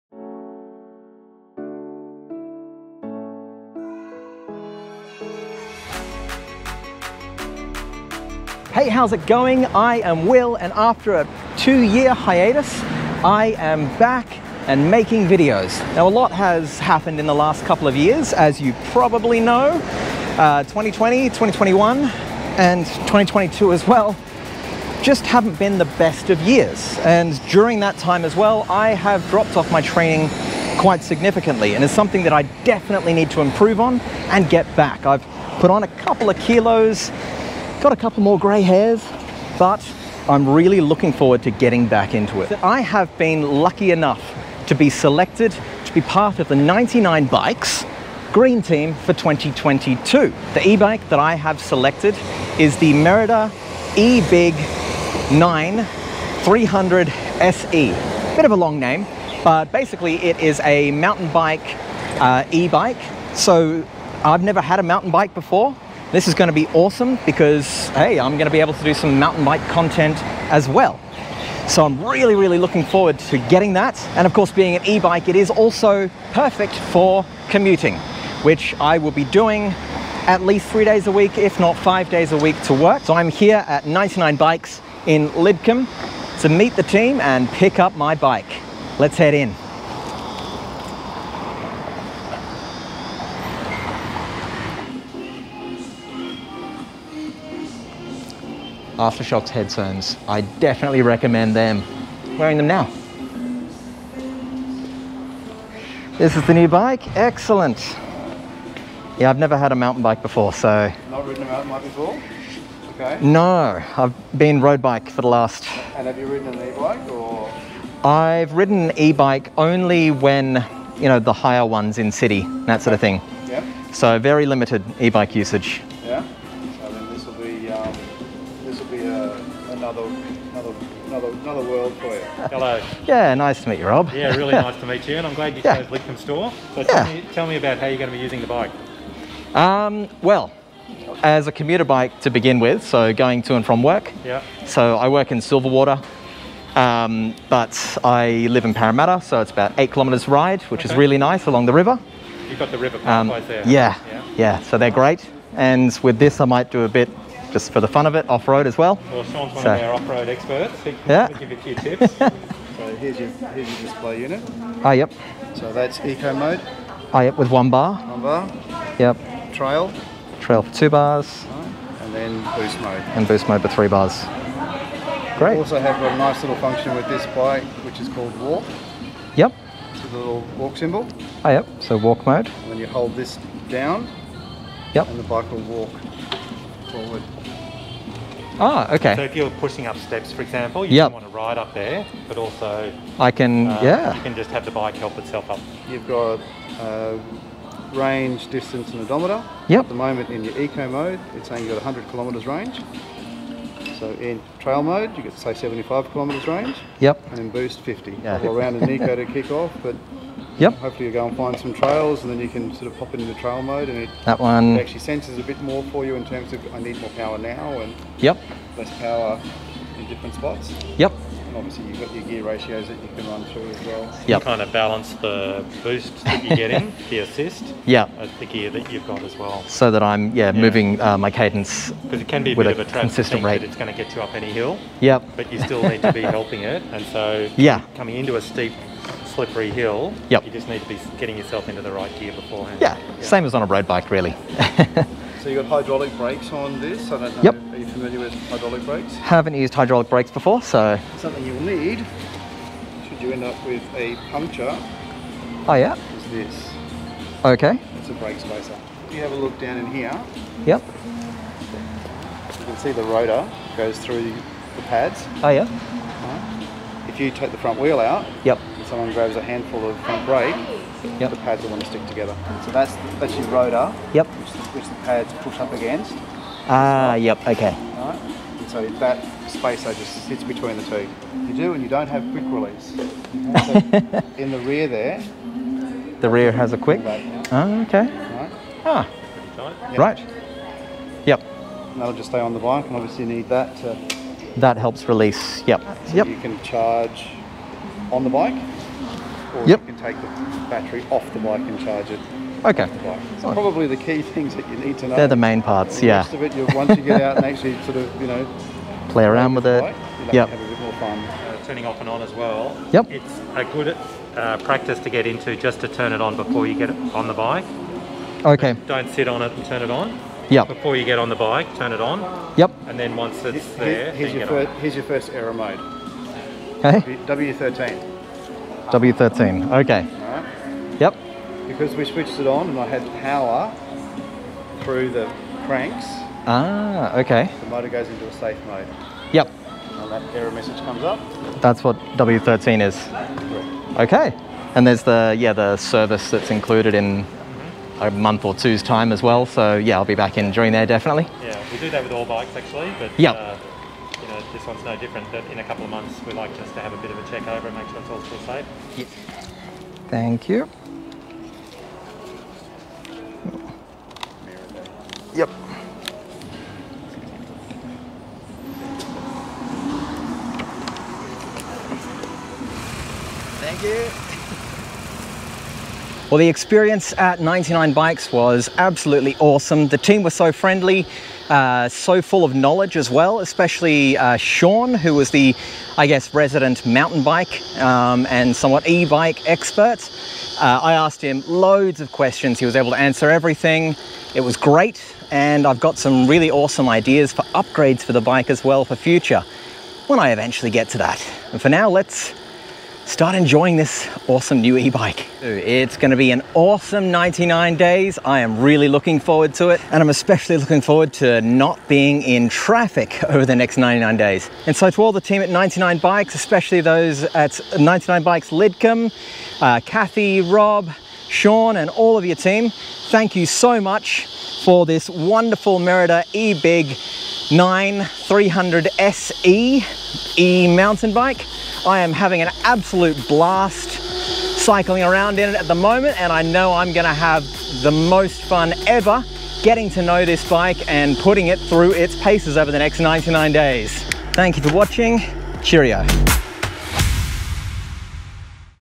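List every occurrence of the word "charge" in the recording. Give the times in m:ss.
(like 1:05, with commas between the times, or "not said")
4:56, 5:01.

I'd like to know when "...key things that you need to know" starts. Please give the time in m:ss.
5:03.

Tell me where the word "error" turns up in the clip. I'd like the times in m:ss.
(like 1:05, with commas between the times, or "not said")
5:25, 5:40.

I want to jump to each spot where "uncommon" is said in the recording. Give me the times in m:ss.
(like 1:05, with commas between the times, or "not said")
not said.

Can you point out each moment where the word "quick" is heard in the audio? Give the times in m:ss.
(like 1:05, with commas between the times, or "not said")
4:42, 4:46.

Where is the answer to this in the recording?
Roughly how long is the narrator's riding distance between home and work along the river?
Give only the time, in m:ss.
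2:29.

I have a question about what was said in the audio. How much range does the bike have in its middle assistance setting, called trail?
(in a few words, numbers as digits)
75 kilometres.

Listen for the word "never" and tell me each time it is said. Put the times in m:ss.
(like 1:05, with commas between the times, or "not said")
1:04, 1:49.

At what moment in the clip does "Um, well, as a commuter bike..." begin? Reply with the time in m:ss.
2:19.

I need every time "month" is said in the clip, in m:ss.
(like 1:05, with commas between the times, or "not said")
5:48, 5:55.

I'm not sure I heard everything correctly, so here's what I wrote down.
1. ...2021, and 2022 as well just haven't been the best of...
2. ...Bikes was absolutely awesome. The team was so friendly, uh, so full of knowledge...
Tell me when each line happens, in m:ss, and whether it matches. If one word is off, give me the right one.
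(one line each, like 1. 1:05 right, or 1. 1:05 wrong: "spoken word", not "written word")
1. 0:21 right
2. 6:17 right.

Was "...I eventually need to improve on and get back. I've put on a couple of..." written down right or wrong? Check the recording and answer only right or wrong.
wrong.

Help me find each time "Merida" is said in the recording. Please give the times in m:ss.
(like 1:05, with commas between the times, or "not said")
0:52, 7:05.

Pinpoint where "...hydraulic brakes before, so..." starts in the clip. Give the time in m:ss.
4:09.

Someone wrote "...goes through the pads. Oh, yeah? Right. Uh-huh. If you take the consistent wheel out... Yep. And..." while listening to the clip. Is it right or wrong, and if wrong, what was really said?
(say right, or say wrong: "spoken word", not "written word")
wrong: "front", not "consistent".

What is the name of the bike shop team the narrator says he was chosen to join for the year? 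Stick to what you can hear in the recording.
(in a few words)
99 Bikes green team.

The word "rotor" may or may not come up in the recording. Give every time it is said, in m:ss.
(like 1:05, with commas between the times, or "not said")
4:23, 4:33.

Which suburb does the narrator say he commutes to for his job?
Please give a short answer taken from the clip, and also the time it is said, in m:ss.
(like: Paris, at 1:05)
Silverwater, at 2:25.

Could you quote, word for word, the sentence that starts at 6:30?
Uh, I asked him loads of questions.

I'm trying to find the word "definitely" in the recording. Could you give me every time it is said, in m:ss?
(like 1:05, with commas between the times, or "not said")
0:32, 1:40, 5:50.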